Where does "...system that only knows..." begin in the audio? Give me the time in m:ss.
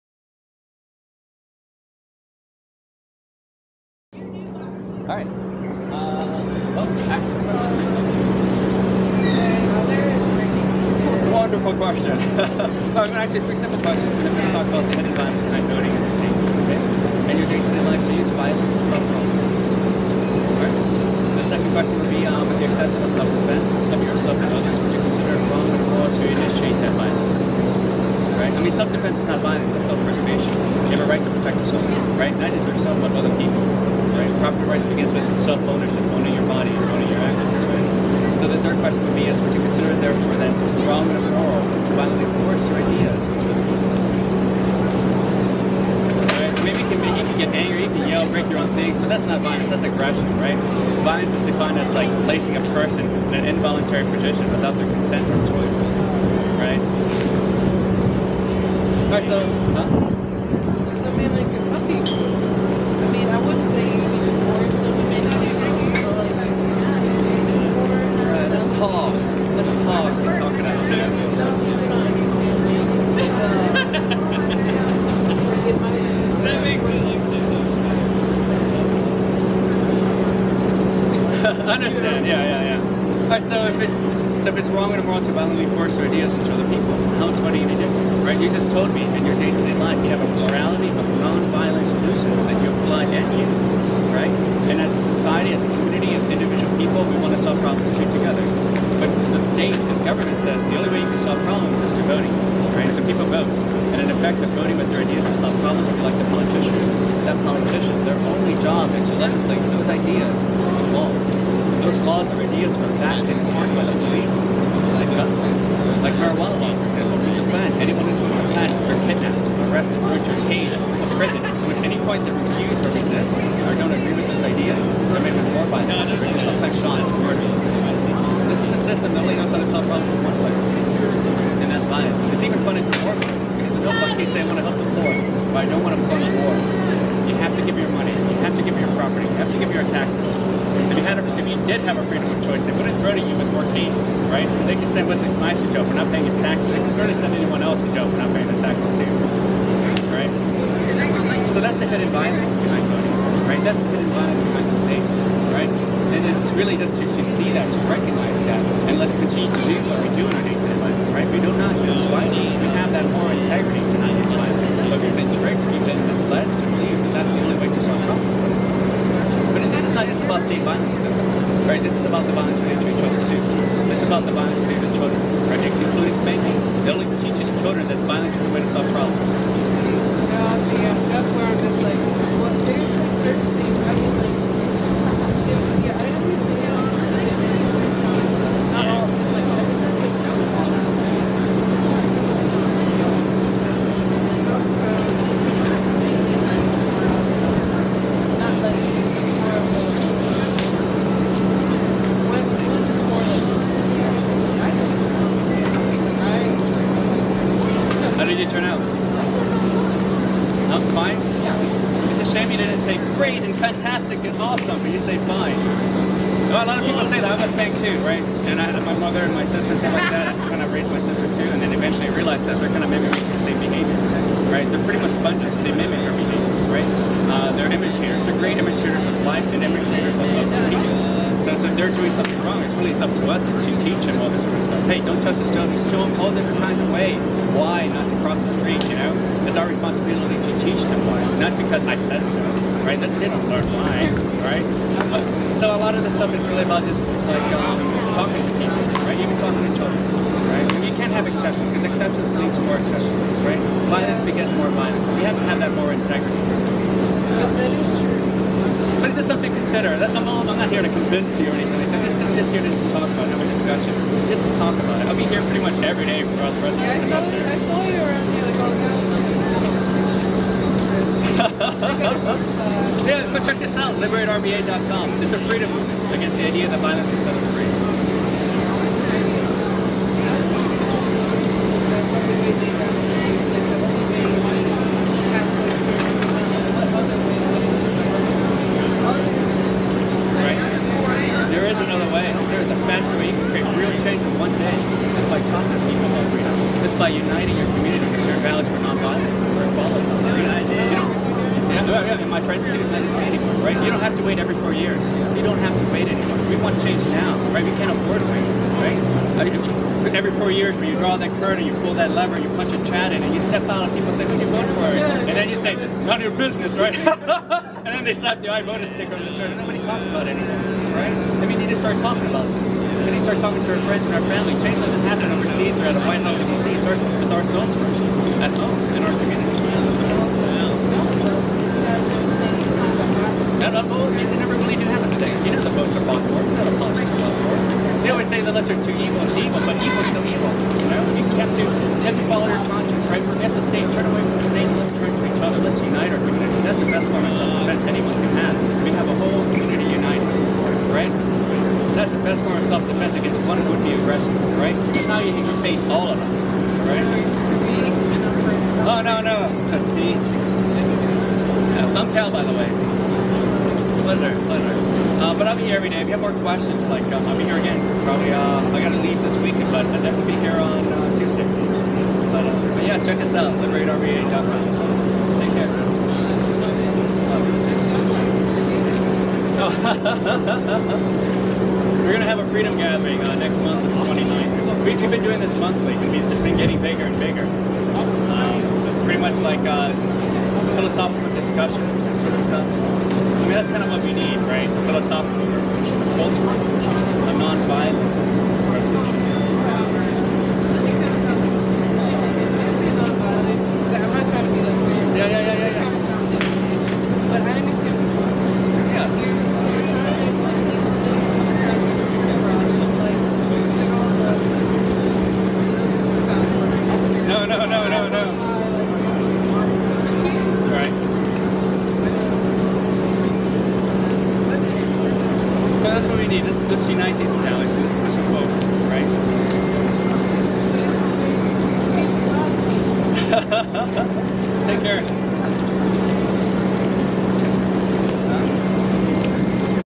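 2:08.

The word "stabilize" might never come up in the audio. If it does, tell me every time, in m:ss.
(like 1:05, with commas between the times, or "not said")
not said.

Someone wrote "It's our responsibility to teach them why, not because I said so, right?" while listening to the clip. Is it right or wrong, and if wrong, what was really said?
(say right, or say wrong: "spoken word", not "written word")
right.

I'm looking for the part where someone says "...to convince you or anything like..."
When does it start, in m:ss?
4:20.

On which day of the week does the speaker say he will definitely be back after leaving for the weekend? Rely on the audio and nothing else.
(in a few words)
Tuesday.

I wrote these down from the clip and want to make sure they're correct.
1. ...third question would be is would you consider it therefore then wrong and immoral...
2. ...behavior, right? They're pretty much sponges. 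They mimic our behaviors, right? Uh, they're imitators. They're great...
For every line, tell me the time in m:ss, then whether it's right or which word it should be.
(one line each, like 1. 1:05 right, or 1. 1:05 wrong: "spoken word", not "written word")
1. 0:38 right
2. 3:43 right.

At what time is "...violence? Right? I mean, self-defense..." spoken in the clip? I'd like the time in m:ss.
0:26.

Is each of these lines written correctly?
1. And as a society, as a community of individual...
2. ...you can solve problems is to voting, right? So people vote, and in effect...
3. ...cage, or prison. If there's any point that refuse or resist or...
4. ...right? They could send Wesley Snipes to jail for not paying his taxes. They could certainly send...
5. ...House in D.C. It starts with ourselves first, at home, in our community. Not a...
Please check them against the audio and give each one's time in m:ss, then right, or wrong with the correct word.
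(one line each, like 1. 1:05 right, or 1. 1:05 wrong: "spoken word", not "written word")
1. 1:34 right
2. 1:41 right
3. 2:00 right
4. 2:24 right
5. 5:26 right.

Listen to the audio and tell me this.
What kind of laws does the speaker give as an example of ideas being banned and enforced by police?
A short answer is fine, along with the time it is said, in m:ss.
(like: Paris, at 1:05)
Marijuana laws, at 1:56.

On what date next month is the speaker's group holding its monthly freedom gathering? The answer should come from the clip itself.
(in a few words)
29th.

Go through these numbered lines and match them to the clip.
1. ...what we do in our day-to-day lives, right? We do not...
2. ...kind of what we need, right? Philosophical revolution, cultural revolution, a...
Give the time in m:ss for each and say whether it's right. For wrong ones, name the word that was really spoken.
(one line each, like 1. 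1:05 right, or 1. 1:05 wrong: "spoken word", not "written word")
1. 2:39 right
2. 6:33 right.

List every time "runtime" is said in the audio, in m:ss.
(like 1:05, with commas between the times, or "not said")
not said.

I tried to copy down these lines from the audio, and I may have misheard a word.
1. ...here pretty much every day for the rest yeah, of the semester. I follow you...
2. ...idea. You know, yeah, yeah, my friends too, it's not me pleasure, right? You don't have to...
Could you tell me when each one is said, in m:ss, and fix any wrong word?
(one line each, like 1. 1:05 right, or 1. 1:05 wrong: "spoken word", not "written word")
1. 4:25 right
2. 5:00 wrong: "anymore", not "pleasure".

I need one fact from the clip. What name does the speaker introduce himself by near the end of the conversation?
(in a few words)
Kal.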